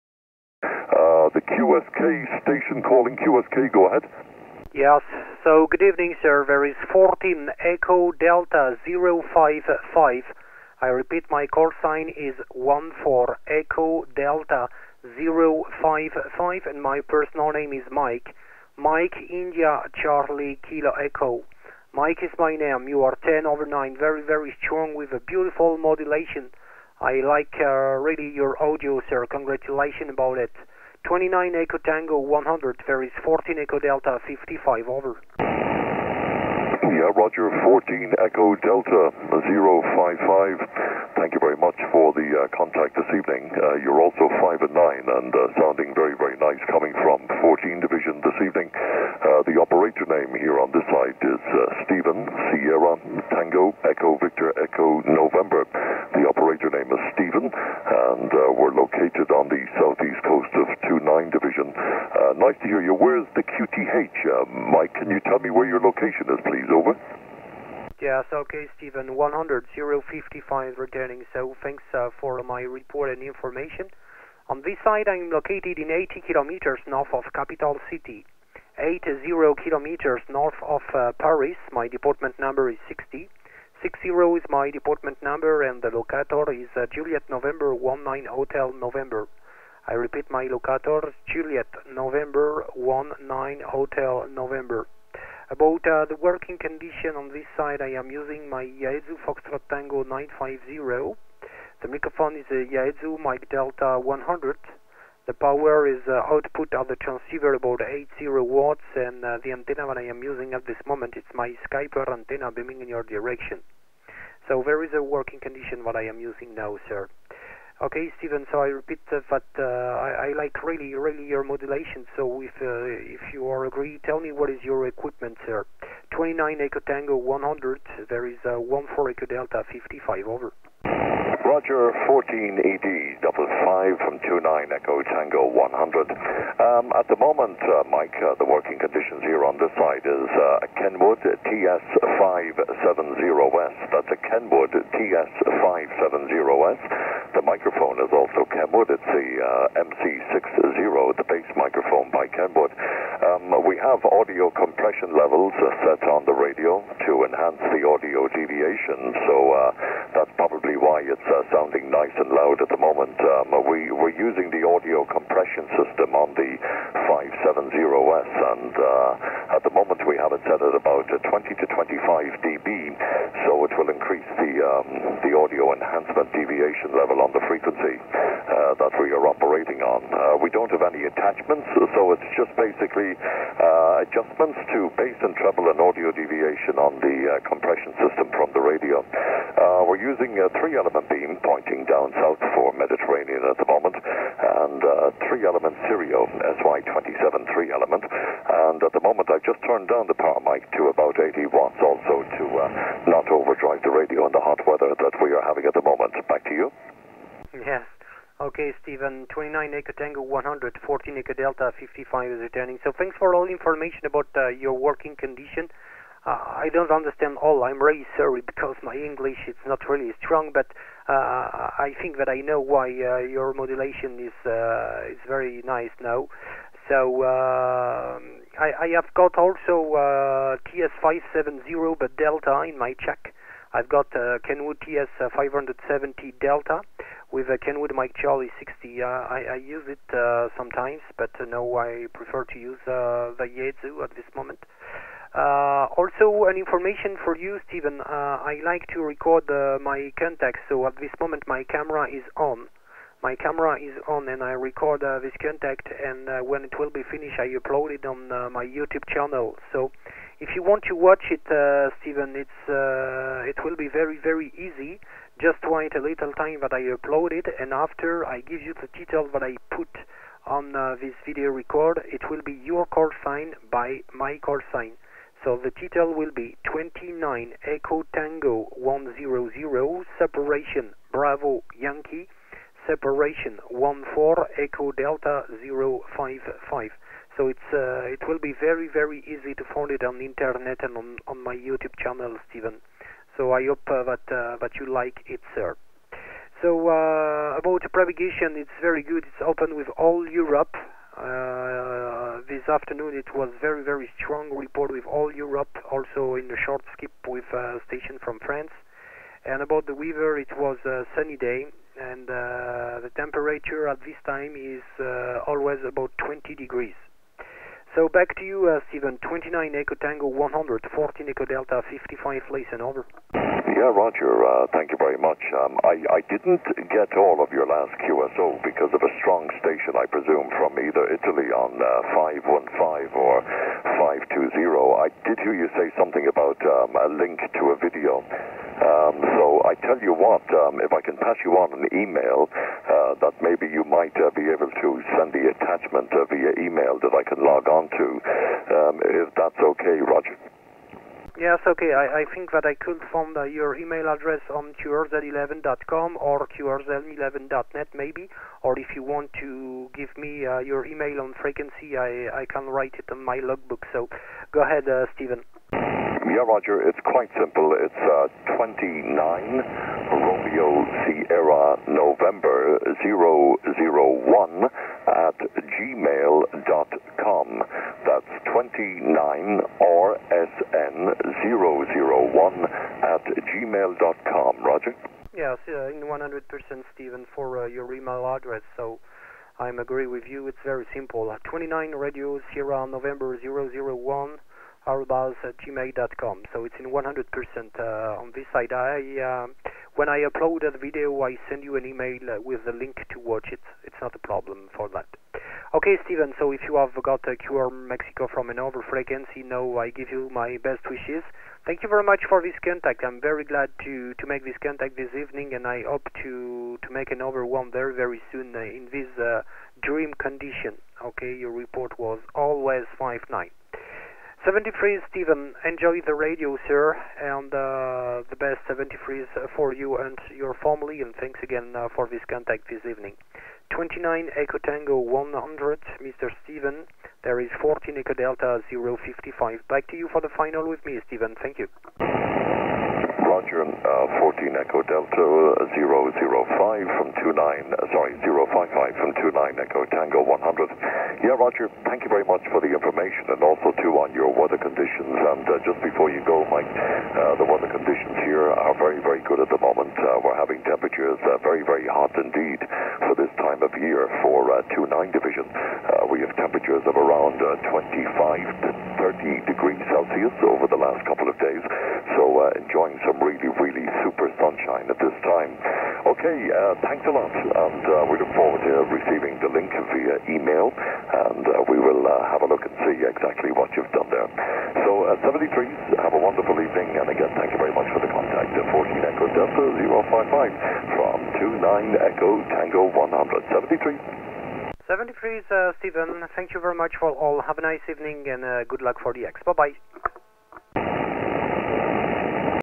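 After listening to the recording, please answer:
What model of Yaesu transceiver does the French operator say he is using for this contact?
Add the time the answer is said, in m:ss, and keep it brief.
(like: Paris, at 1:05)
FT-950, at 1:39.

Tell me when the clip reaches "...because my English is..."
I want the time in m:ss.
3:38.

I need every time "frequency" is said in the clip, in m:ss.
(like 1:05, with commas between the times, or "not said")
2:57, 6:01, 6:48.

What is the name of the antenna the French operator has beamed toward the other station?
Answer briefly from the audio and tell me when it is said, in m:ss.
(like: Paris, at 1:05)
Skyper, at 1:51.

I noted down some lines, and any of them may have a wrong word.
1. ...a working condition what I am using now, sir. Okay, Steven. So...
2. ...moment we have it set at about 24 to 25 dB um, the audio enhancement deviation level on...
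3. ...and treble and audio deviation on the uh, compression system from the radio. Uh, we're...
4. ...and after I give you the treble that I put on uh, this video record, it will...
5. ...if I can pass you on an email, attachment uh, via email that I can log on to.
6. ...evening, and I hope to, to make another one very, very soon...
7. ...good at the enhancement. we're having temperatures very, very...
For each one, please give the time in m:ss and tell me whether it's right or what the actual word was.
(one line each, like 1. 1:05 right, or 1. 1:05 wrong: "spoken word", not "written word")
1. 1:54 right
2. 2:49 wrong: "20", not "24"
3. 3:05 right
4. 4:27 wrong: "title", not "treble"
5. 5:40 right
6. 6:55 right
7. 7:39 wrong: "moment", not "enhancement".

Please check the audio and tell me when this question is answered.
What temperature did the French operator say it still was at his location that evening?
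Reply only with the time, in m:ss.
5:16.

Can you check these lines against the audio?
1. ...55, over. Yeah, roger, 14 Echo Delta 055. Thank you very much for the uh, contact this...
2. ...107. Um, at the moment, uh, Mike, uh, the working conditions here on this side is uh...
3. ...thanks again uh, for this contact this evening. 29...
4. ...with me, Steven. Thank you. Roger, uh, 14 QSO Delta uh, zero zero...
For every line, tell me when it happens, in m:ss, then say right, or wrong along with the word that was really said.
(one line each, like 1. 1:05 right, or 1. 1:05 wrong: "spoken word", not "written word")
1. 0:34 right
2. 2:15 wrong: "100", not "107"
3. 7:11 right
4. 7:20 wrong: "Echo", not "QSO".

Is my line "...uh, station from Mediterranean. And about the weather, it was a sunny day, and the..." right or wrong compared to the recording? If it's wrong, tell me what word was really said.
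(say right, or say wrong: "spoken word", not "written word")
wrong: "France", not "Mediterranean".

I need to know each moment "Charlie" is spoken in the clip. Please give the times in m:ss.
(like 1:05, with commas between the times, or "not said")
0:20, 3:58.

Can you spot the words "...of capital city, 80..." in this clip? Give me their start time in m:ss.
1:17.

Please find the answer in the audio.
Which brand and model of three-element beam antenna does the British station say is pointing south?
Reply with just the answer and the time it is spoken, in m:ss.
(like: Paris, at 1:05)
Sirio SY27, at 3:15.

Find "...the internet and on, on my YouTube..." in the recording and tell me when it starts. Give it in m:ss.
4:50.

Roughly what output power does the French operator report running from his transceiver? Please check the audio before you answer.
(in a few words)
80 watts.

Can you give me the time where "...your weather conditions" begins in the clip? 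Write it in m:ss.
7:34.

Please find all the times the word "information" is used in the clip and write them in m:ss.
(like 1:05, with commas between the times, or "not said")
1:13, 3:33, 4:06, 7:32.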